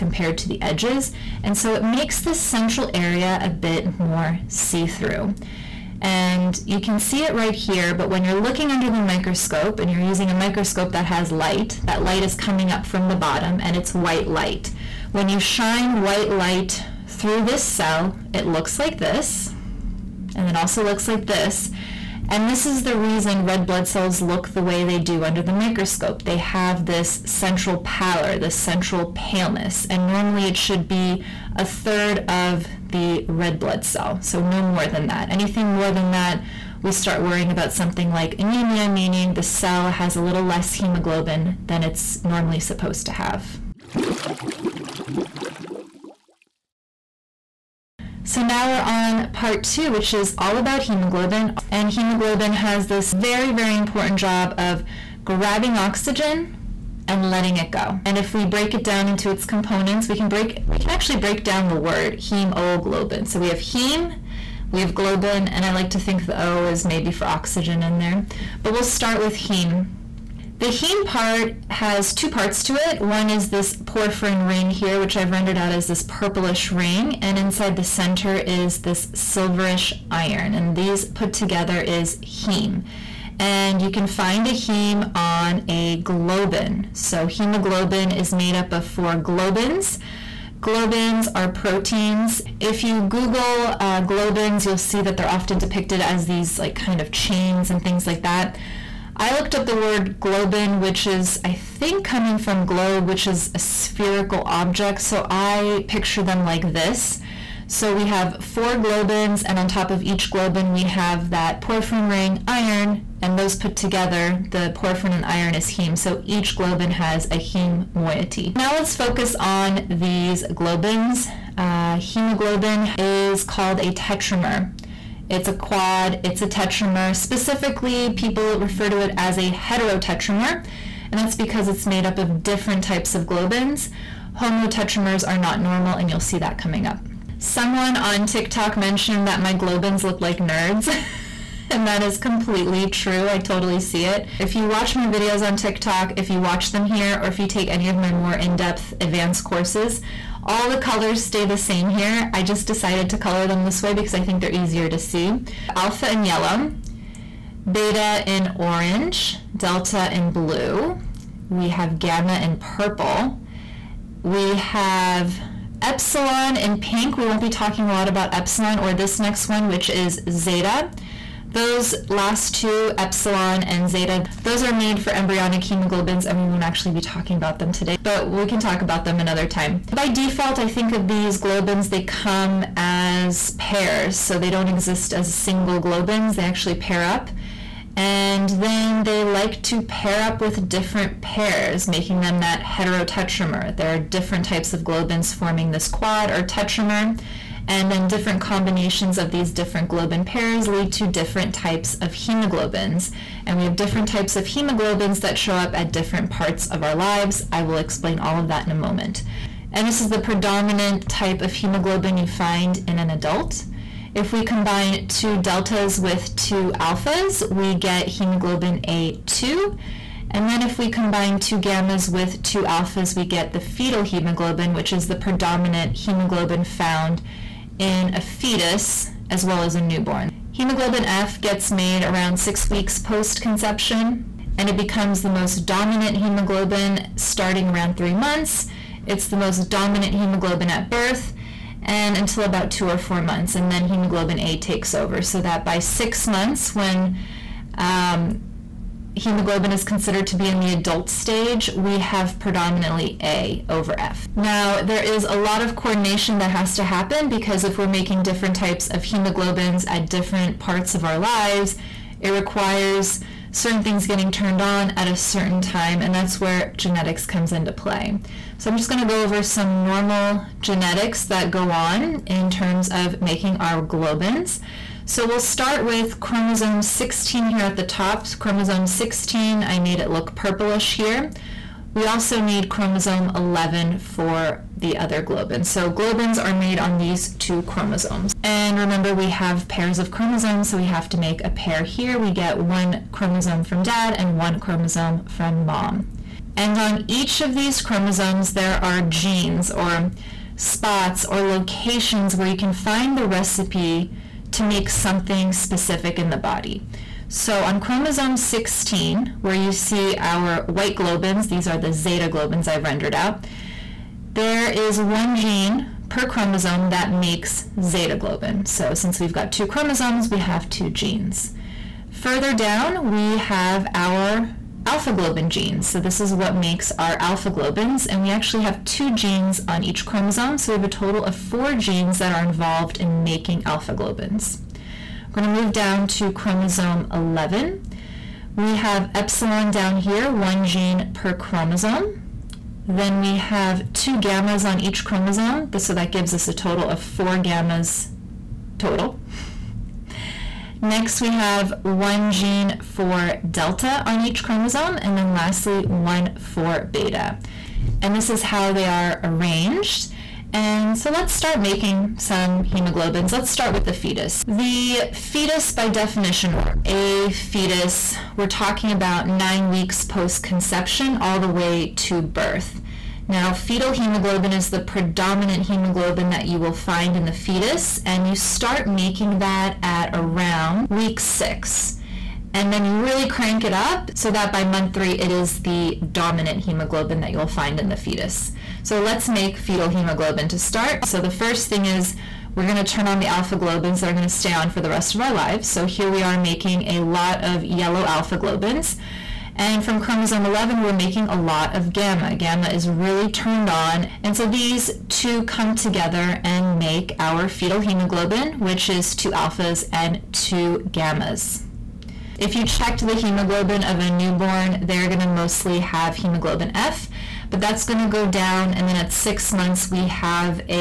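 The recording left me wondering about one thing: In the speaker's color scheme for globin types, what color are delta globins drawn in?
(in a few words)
blue.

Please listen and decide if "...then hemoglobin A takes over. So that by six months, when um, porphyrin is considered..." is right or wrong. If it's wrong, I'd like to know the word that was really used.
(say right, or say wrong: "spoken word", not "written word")
wrong: "hemoglobin", not "porphyrin".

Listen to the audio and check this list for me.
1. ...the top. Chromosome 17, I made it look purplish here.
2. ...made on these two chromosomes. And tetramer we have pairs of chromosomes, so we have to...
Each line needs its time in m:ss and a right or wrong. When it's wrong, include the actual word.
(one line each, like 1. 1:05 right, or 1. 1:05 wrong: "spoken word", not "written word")
1. 4:37 wrong: "16", not "17"
2. 4:46 wrong: "remember", not "tetramer".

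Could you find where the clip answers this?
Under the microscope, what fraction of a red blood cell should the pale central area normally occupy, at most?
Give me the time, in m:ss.
0:31.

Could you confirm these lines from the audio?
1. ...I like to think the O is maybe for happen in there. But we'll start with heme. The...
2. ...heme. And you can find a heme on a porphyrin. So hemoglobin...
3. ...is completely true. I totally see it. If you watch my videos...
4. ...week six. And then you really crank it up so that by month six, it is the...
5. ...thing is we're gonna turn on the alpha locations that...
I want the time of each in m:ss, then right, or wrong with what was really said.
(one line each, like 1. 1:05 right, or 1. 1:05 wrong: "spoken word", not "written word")
1. 1:05 wrong: "oxygen", not "happen"
2. 1:22 wrong: "globin", not "porphyrin"
3. 2:22 right
4. 6:20 wrong: "three", not "six"
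5. 6:31 wrong: "globins", not "locations".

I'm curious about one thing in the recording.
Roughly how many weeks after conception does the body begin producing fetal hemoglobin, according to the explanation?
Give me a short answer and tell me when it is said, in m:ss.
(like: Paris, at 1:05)
6 weeks, at 3:52.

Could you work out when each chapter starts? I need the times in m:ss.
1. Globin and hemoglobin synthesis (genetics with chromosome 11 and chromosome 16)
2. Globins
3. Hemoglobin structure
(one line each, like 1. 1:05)
1. 4:37
2. 2:01
3. 1:03.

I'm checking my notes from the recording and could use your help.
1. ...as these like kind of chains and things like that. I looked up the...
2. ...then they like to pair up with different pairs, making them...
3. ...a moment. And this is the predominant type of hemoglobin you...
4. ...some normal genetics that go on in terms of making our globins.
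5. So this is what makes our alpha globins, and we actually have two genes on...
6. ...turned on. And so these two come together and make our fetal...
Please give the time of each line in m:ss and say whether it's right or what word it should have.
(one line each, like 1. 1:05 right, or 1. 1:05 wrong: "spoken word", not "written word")
1. 1:36 right
2. 3:08 right
3. 3:28 right
4. 4:29 right
5. 5:25 right
6. 6:43 right.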